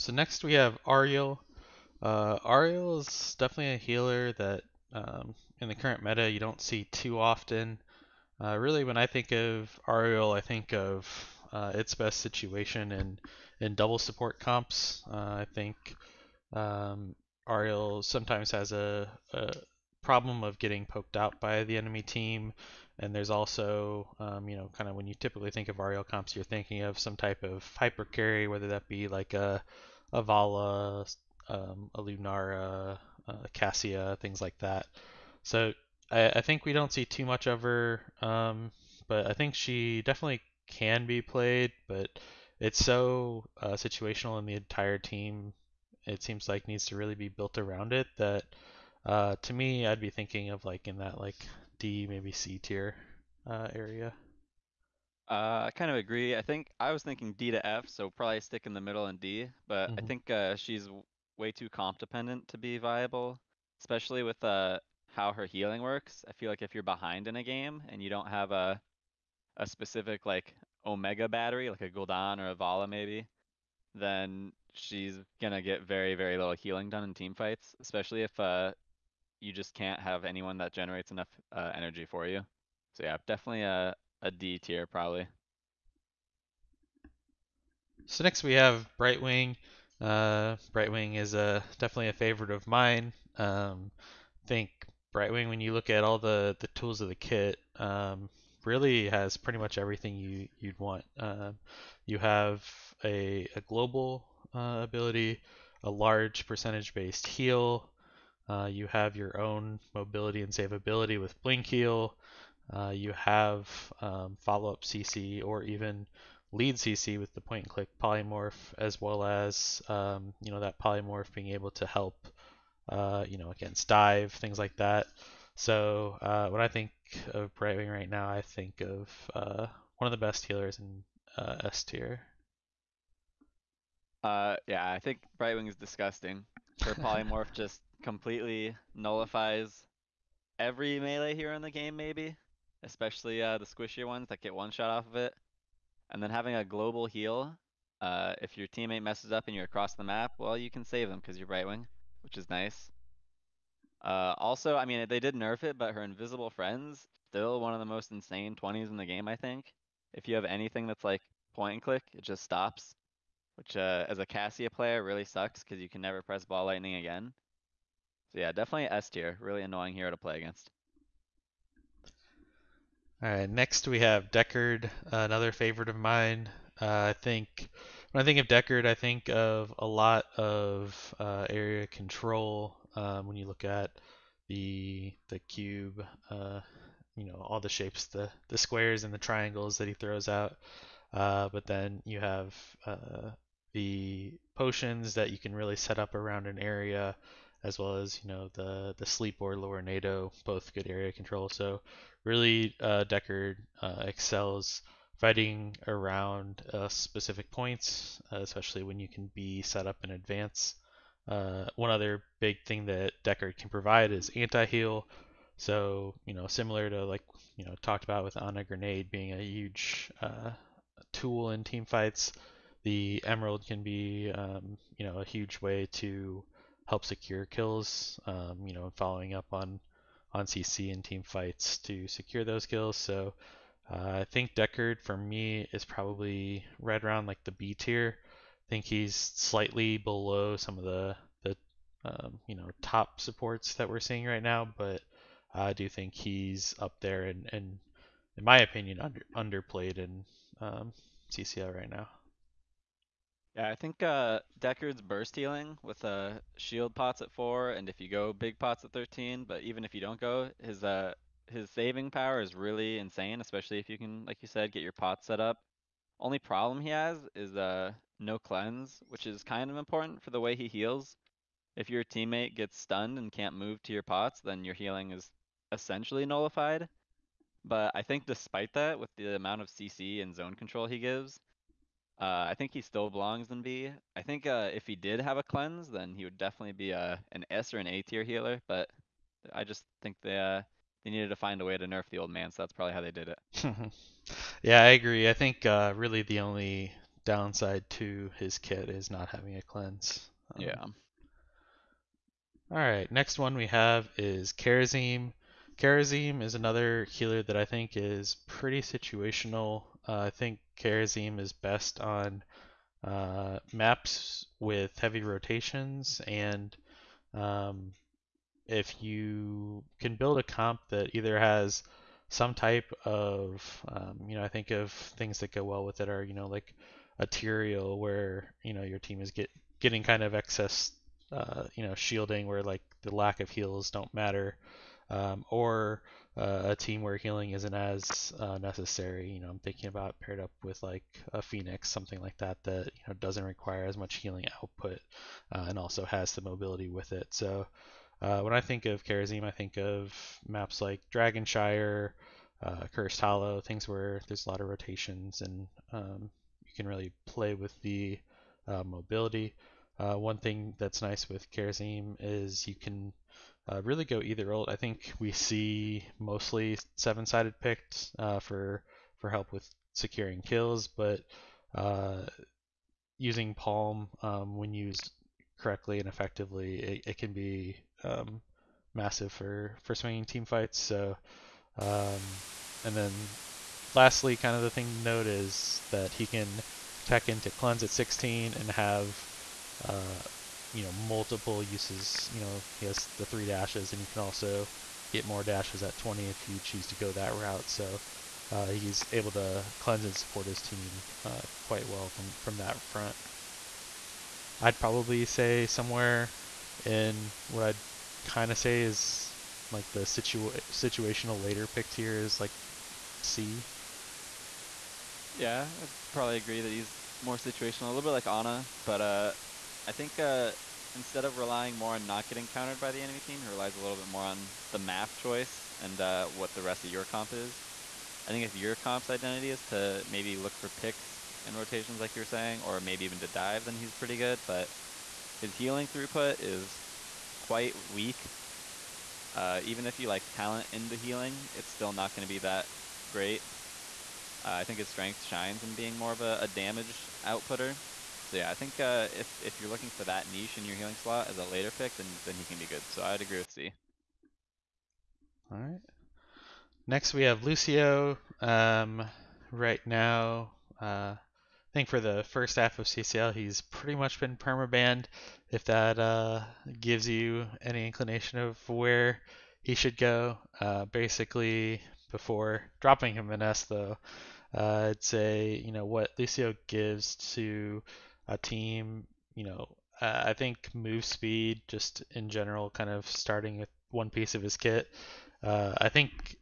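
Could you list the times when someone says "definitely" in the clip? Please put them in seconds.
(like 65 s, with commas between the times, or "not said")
3 s, 40 s, 83 s, 91 s, 168 s, 286 s.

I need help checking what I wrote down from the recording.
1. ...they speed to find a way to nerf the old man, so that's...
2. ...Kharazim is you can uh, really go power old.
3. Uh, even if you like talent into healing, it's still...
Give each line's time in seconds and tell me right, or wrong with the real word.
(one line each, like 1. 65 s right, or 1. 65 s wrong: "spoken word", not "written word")
1. 291 s wrong: "needed", not "speed"
2. 361 s wrong: "either", not "power"
3. 439 s right.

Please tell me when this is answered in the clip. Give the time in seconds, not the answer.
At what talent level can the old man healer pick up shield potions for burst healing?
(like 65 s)
257 s.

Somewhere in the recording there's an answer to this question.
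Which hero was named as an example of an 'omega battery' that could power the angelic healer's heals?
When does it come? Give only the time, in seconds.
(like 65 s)
71 s.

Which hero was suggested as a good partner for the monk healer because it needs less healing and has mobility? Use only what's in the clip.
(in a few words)
Fenix.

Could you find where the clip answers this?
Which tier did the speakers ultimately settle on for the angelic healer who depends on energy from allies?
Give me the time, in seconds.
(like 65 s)
84 s.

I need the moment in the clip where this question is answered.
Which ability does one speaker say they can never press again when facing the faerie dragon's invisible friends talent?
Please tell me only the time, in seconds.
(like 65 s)
166 s.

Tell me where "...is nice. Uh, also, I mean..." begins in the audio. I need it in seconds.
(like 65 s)
152 s.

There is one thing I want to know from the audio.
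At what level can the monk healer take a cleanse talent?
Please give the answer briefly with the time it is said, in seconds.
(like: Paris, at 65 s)
16, at 387 s.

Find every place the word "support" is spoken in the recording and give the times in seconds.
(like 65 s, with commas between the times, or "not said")
13 s, 243 s, 400 s.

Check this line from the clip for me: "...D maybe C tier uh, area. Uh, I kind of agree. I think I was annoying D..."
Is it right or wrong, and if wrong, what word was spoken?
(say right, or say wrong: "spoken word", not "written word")
wrong: "thinking", not "annoying".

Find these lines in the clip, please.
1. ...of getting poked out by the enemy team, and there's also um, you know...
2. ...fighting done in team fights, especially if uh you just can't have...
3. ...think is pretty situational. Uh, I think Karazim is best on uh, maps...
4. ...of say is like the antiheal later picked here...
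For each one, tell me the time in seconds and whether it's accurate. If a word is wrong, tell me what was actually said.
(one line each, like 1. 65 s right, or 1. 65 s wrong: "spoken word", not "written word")
1. 20 s right
2. 76 s wrong: "healing", not "fighting"
3. 307 s right
4. 408 s wrong: "situational", not "antiheal".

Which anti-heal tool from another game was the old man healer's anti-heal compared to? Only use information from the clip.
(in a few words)
Ana Grenade.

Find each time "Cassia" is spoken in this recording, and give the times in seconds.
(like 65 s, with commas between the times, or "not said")
33 s, 164 s.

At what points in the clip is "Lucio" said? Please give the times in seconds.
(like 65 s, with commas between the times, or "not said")
457 s, 476 s.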